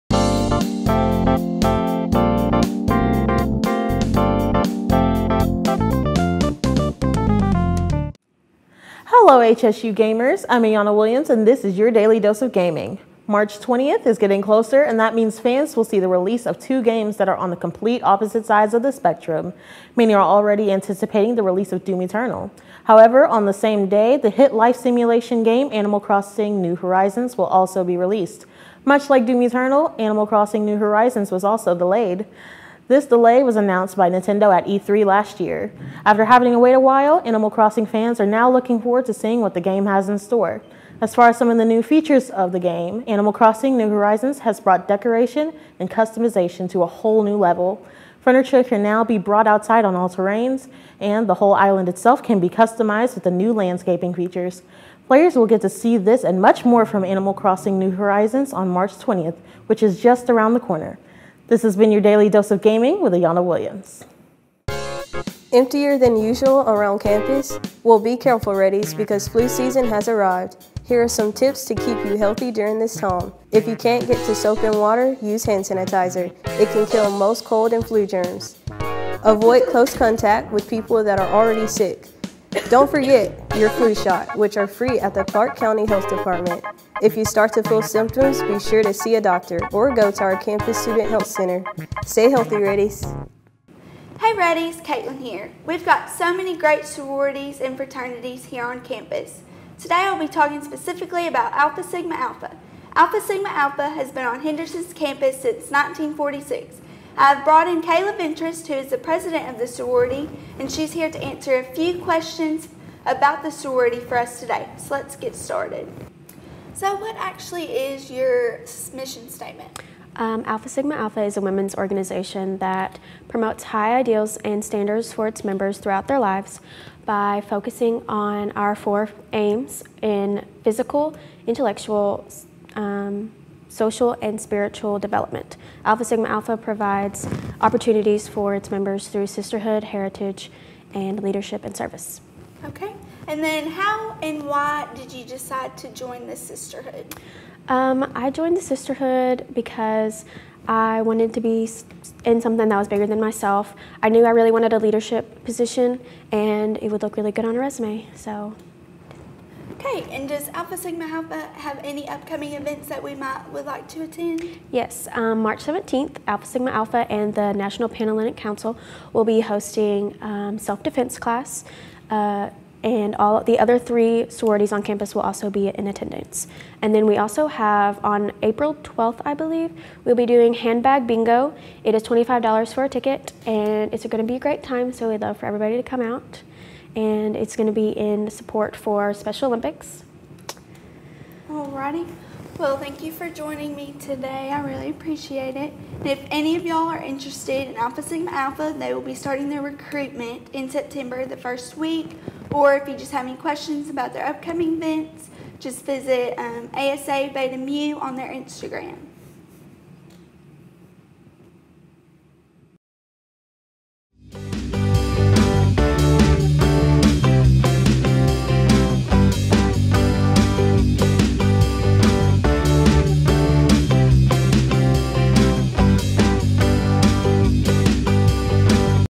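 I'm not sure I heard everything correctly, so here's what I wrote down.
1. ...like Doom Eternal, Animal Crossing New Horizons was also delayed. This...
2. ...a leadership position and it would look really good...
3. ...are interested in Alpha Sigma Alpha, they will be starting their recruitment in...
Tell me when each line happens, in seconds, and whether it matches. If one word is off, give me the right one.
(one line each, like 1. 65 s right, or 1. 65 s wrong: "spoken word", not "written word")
1. 29 s right
2. 154 s right
3. 196 s right.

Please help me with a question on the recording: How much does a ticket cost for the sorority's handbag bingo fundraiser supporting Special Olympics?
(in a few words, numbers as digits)
$25.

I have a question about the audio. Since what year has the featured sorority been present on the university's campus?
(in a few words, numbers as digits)
1946.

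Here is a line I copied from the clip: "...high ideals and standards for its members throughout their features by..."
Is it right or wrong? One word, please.
wrong.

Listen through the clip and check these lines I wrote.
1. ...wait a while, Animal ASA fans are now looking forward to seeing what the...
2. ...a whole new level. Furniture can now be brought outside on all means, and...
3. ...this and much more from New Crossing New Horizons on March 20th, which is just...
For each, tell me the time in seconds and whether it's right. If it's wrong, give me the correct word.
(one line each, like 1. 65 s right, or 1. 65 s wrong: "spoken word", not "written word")
1. 36 s wrong: "Crossing", not "ASA"
2. 46 s wrong: "terrains", not "means"
3. 55 s wrong: "Animal", not "New".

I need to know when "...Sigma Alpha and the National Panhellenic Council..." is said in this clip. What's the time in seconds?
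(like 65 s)
166 s.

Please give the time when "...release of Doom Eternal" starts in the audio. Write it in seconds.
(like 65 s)
21 s.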